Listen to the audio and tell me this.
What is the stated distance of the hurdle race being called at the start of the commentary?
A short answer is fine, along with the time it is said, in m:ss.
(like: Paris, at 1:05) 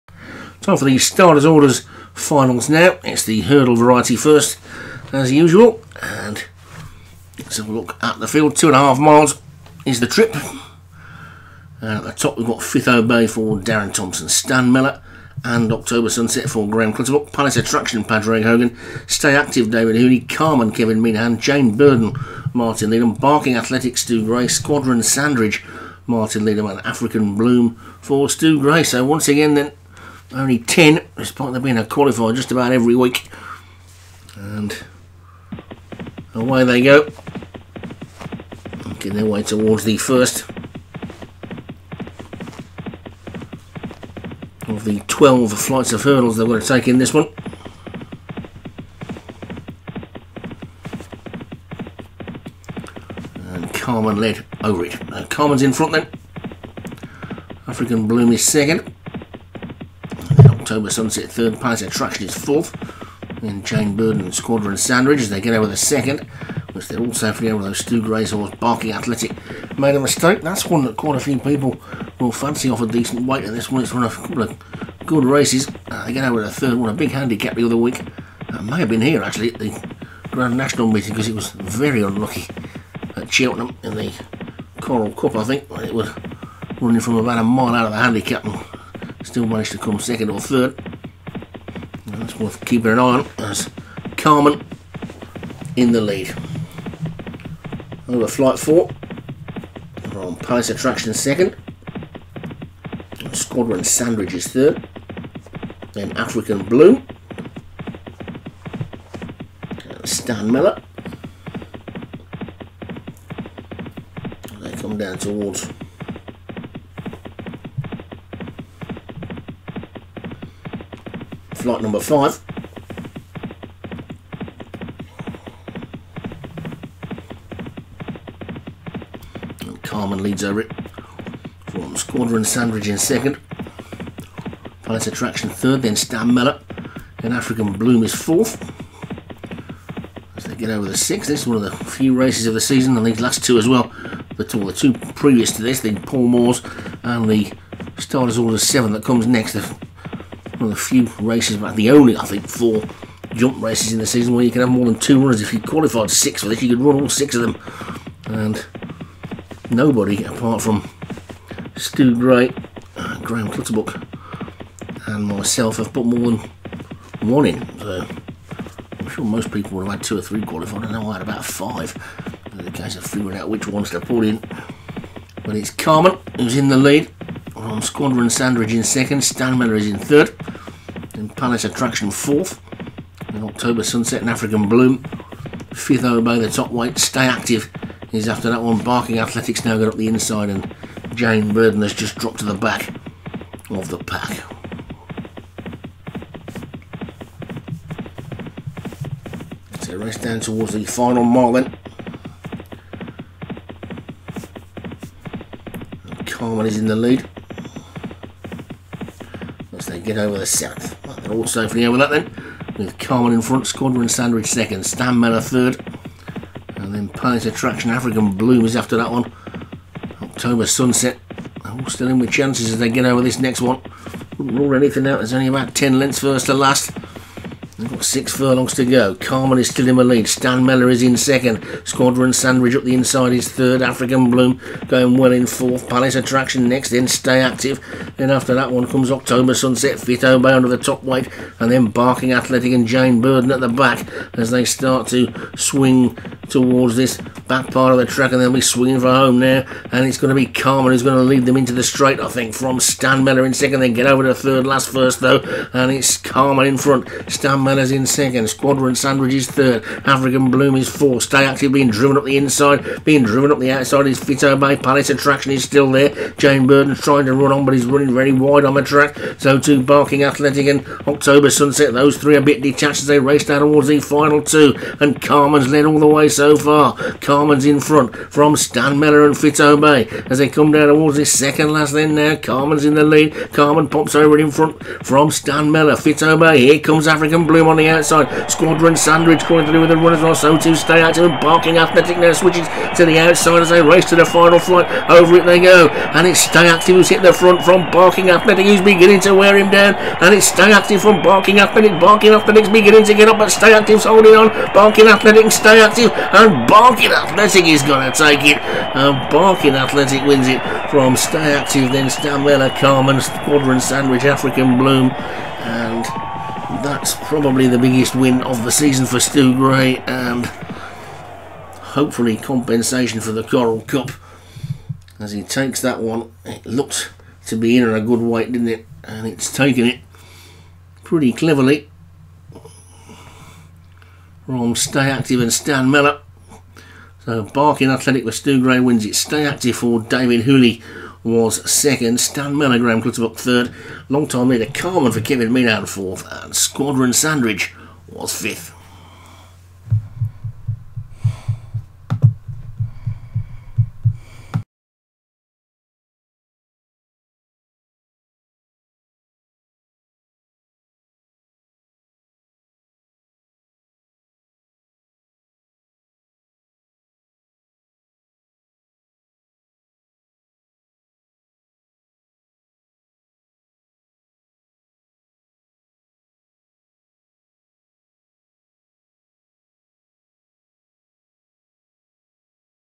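Two and a half miles, at 0:08.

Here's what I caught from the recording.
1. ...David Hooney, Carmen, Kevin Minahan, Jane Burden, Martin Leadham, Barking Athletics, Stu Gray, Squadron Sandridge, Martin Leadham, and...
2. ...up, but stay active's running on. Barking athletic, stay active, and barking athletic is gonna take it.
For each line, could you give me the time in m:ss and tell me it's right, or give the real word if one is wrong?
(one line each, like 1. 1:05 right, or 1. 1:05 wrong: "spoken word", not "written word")
1. 0:19 right
2. 5:03 wrong: "holding", not "running".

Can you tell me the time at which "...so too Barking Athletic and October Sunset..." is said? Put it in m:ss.
4:29.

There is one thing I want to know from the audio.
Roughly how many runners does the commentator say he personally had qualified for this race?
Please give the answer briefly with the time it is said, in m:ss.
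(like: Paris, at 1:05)
About 5, at 2:51.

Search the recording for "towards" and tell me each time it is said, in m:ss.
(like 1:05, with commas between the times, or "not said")
0:39, 1:55, 3:20, 4:06, 4:33, 4:40.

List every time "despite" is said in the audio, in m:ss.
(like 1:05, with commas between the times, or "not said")
0:31.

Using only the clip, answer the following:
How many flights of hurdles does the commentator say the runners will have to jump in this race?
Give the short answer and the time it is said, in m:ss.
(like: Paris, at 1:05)
12, at 0:45.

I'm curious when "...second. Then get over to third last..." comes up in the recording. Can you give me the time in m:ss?
4:13.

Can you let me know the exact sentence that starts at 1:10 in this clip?
That's one that quite a few people will fancy off a decent weight at this one.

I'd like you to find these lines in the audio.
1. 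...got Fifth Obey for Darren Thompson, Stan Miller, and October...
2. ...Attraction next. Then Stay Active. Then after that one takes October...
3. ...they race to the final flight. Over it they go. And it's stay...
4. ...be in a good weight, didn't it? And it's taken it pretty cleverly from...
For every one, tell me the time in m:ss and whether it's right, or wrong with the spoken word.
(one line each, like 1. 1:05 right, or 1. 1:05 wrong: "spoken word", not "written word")
1. 0:12 right
2. 3:56 wrong: "comes", not "takes"
3. 4:53 right
4. 5:27 right.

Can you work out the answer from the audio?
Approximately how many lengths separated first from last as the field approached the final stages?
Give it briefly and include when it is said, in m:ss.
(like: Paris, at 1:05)
10, at 3:45.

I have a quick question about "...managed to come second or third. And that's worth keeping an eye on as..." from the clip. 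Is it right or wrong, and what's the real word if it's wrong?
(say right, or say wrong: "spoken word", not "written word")
right.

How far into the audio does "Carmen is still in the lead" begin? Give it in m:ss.
3:49.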